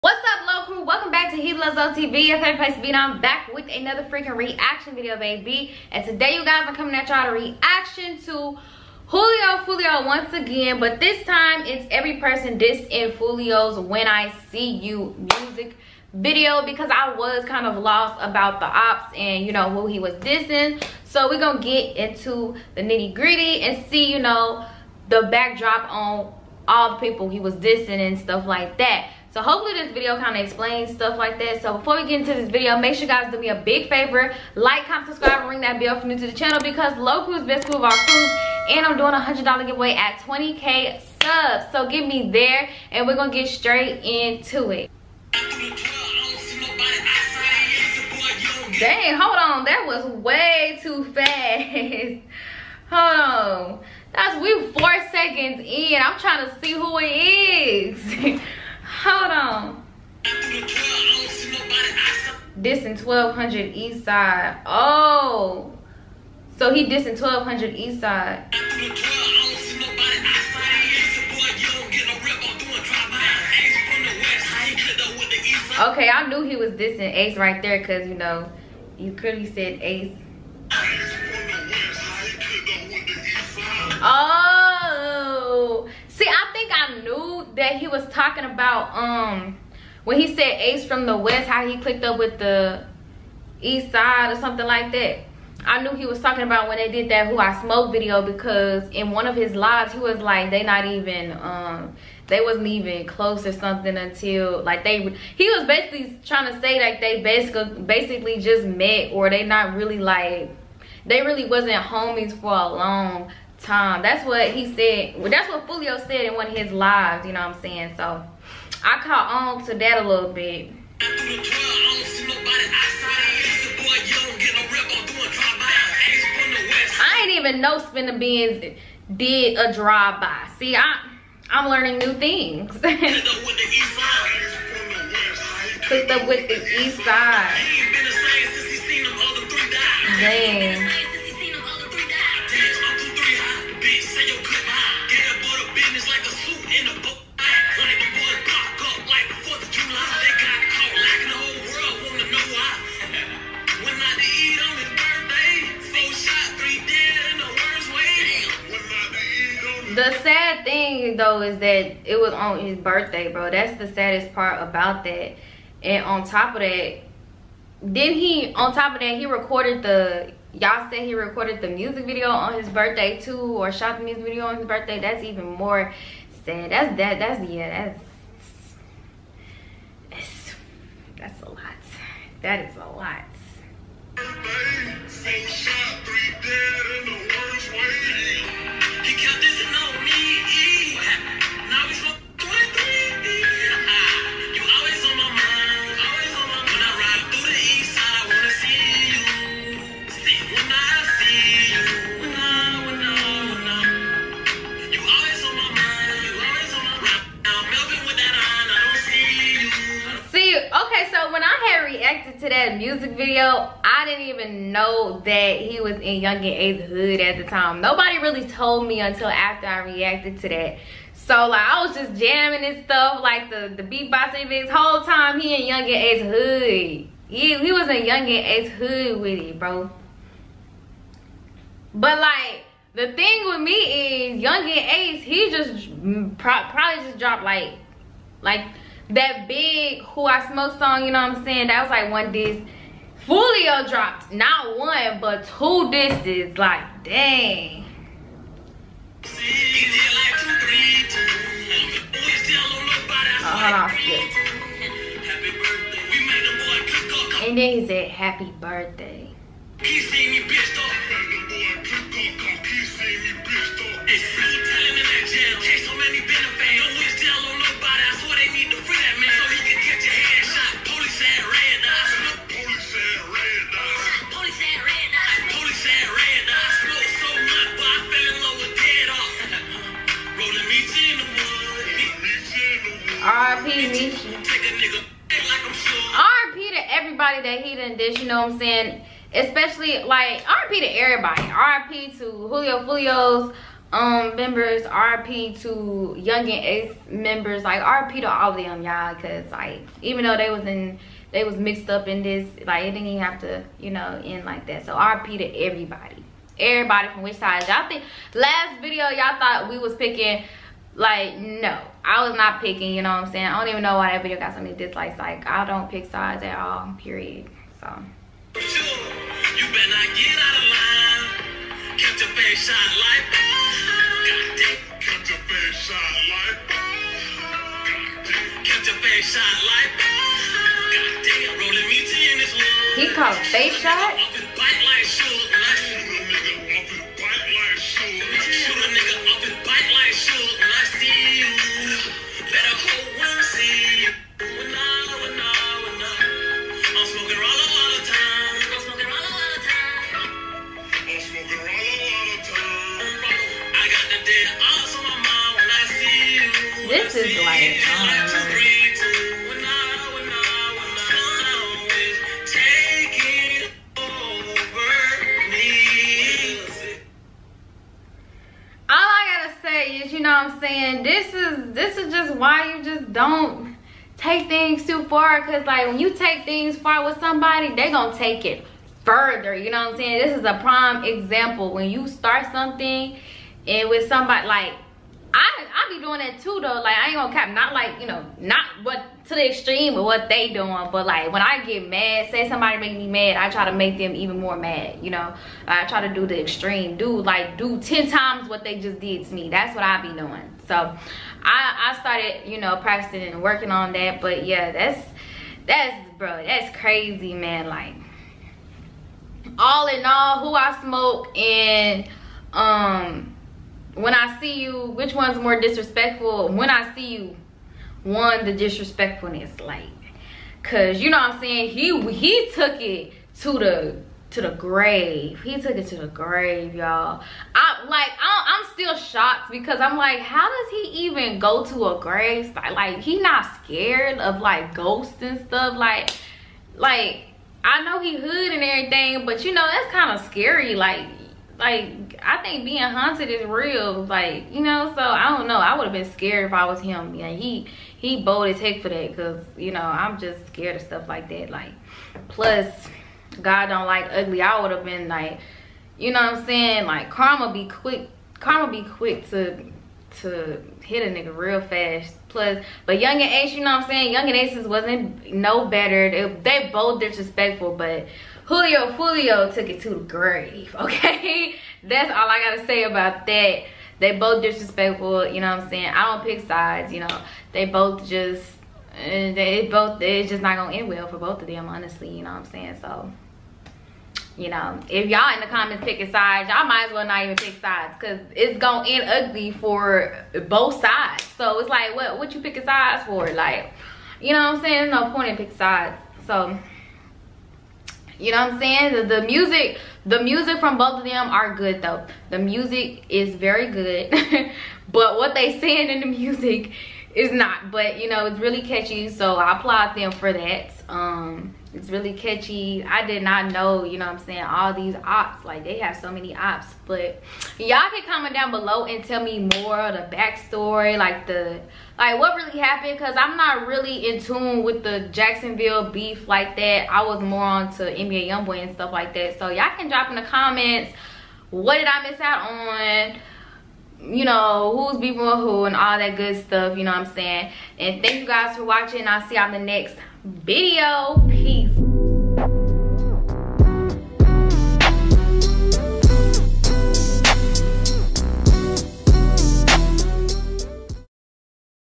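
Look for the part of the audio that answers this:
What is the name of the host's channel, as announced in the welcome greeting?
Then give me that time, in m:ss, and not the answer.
0:01.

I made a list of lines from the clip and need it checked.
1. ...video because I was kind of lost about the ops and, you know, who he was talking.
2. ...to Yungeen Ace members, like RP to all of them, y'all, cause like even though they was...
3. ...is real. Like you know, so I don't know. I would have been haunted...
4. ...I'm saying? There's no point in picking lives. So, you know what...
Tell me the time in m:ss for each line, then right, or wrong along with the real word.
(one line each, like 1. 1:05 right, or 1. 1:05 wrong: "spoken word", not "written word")
1. 0:16 wrong: "dissing", not "talking"
2. 4:55 right
3. 7:23 wrong: "scared", not "haunted"
4. 8:14 wrong: "sides", not "lives".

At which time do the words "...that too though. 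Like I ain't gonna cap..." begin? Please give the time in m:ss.
6:26.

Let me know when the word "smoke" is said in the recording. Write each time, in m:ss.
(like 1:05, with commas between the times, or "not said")
1:37, 4:00, 6:50.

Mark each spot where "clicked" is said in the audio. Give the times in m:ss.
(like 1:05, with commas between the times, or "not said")
1:31.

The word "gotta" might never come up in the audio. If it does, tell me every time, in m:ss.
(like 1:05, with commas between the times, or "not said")
7:52.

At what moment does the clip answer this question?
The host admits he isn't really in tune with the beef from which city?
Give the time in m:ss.
8:45.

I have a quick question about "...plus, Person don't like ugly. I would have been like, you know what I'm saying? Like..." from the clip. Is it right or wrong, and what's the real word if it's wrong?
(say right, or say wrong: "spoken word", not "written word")
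wrong: "God", not "Person".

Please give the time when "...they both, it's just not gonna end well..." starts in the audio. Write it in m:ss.
7:59.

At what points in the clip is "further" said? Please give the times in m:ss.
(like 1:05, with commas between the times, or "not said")
6:19.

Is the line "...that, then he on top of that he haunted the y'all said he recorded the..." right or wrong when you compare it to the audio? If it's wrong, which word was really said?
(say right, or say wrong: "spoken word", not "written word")
wrong: "recorded", not "haunted".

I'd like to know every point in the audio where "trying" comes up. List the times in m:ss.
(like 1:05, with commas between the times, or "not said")
0:56, 1:46.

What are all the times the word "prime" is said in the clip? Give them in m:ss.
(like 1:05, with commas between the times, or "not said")
6:20.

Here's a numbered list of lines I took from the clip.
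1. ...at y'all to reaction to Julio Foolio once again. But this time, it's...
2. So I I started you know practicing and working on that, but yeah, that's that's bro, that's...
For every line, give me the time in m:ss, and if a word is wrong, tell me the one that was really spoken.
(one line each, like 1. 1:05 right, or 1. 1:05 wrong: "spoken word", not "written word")
1. 0:06 right
2. 6:40 right.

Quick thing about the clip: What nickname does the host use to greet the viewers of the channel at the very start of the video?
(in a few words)
Low Crew.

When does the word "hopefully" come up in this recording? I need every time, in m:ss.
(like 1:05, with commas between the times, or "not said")
0:29.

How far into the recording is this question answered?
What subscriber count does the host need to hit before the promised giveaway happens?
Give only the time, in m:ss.
0:40.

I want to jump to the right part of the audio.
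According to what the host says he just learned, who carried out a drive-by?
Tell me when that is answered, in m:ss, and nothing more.
2:07.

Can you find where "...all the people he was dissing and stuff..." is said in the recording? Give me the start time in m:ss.
0:26.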